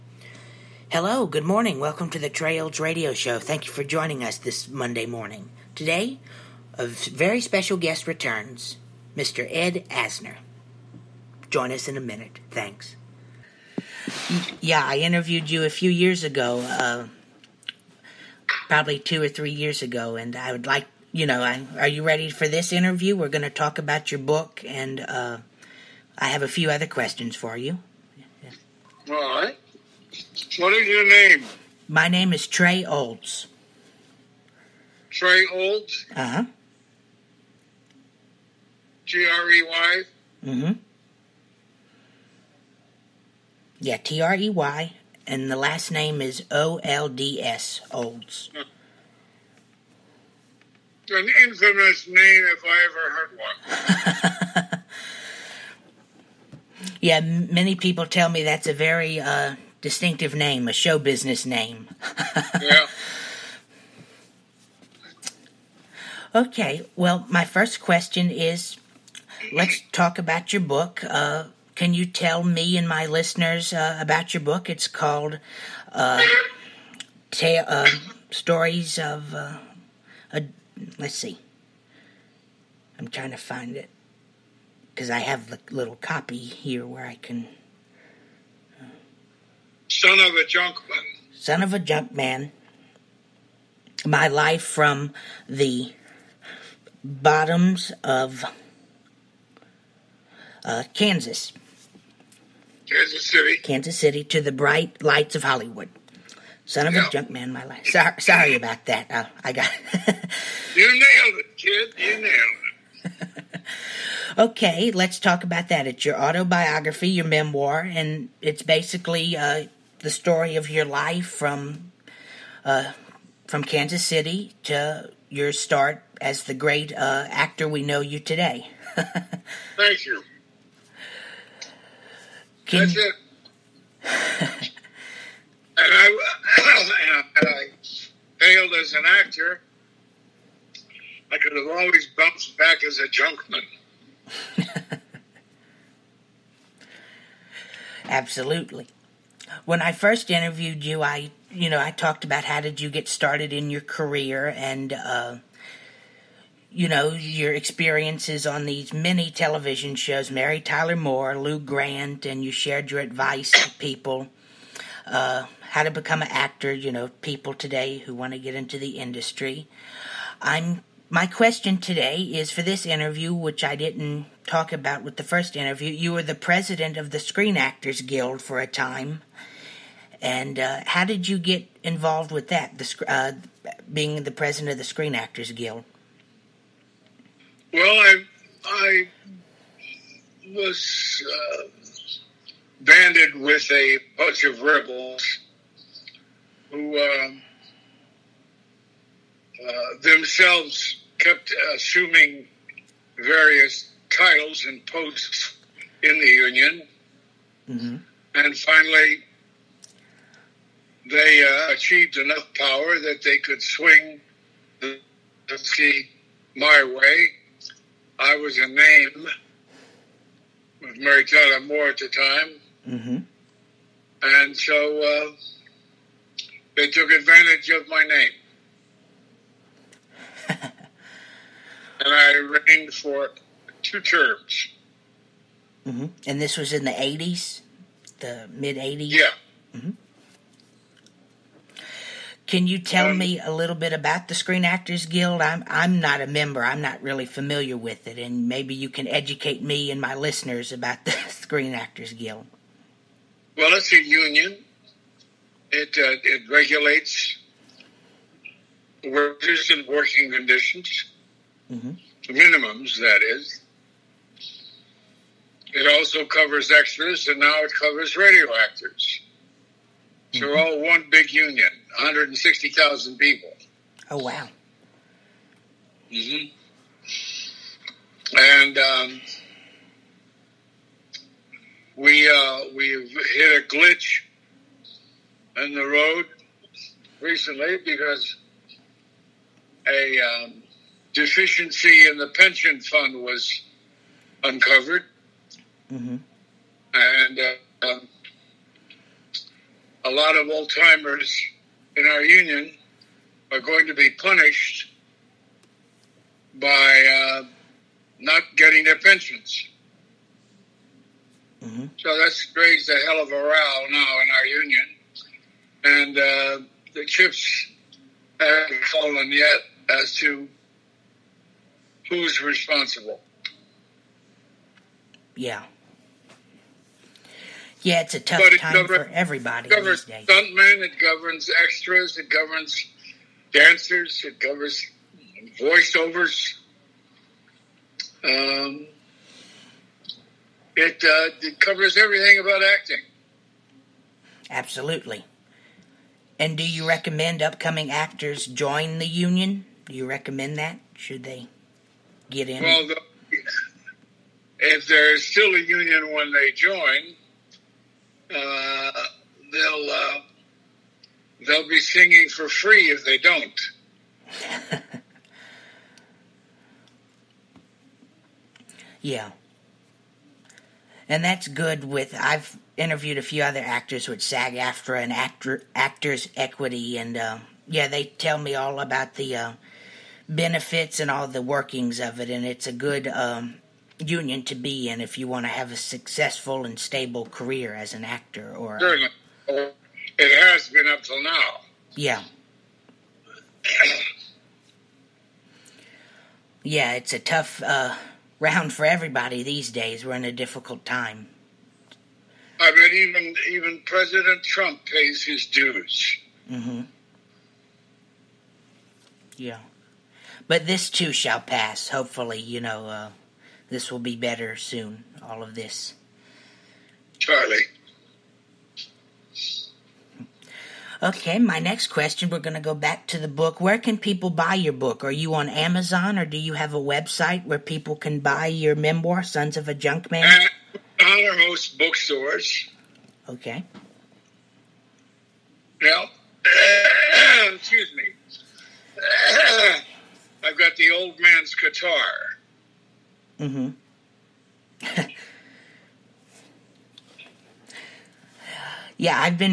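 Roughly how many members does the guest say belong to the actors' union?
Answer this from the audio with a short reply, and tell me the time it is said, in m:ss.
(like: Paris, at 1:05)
160,000, at 4:31.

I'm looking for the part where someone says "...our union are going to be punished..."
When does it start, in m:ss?
5:02.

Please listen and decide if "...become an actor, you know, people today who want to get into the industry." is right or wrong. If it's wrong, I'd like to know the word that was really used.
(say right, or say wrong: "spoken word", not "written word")
right.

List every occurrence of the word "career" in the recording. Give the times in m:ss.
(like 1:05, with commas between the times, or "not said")
2:33, 6:27.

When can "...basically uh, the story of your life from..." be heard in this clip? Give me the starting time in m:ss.
1:58.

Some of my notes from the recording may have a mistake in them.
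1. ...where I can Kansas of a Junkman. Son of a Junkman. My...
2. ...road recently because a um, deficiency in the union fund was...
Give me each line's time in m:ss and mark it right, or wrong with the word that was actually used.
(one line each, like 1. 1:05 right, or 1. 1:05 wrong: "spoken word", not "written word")
1. 1:26 wrong: "Son", not "Kansas"
2. 4:45 wrong: "pension", not "union".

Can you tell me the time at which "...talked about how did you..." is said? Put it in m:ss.
2:31.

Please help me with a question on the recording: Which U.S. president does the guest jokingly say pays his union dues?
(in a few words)
Trump.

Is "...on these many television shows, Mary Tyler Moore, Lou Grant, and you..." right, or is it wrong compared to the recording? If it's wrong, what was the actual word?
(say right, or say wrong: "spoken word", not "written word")
right.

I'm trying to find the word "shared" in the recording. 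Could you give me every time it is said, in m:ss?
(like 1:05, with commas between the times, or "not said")
2:42.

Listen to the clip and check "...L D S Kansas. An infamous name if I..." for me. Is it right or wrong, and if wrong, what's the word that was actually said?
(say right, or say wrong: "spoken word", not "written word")
wrong: "Olds", not "Kansas".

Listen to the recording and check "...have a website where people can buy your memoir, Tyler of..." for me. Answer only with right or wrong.
wrong.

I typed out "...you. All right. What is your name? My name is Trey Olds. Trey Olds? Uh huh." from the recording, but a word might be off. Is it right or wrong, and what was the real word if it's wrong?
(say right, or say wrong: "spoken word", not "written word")
right.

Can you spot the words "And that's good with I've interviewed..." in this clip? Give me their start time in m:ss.
6:11.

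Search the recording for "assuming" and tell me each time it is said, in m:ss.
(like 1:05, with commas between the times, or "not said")
3:21.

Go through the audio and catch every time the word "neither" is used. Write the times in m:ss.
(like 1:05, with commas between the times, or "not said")
not said.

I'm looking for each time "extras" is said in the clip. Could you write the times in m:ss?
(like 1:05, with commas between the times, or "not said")
4:26, 5:31.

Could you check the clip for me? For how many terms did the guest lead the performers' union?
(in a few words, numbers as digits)
2.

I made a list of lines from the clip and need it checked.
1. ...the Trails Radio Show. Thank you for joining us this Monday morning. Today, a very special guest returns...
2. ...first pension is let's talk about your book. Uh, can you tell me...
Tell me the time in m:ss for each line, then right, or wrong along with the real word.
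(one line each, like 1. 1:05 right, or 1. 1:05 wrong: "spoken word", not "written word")
1. 0:02 right
2. 1:07 wrong: "question", not "pension".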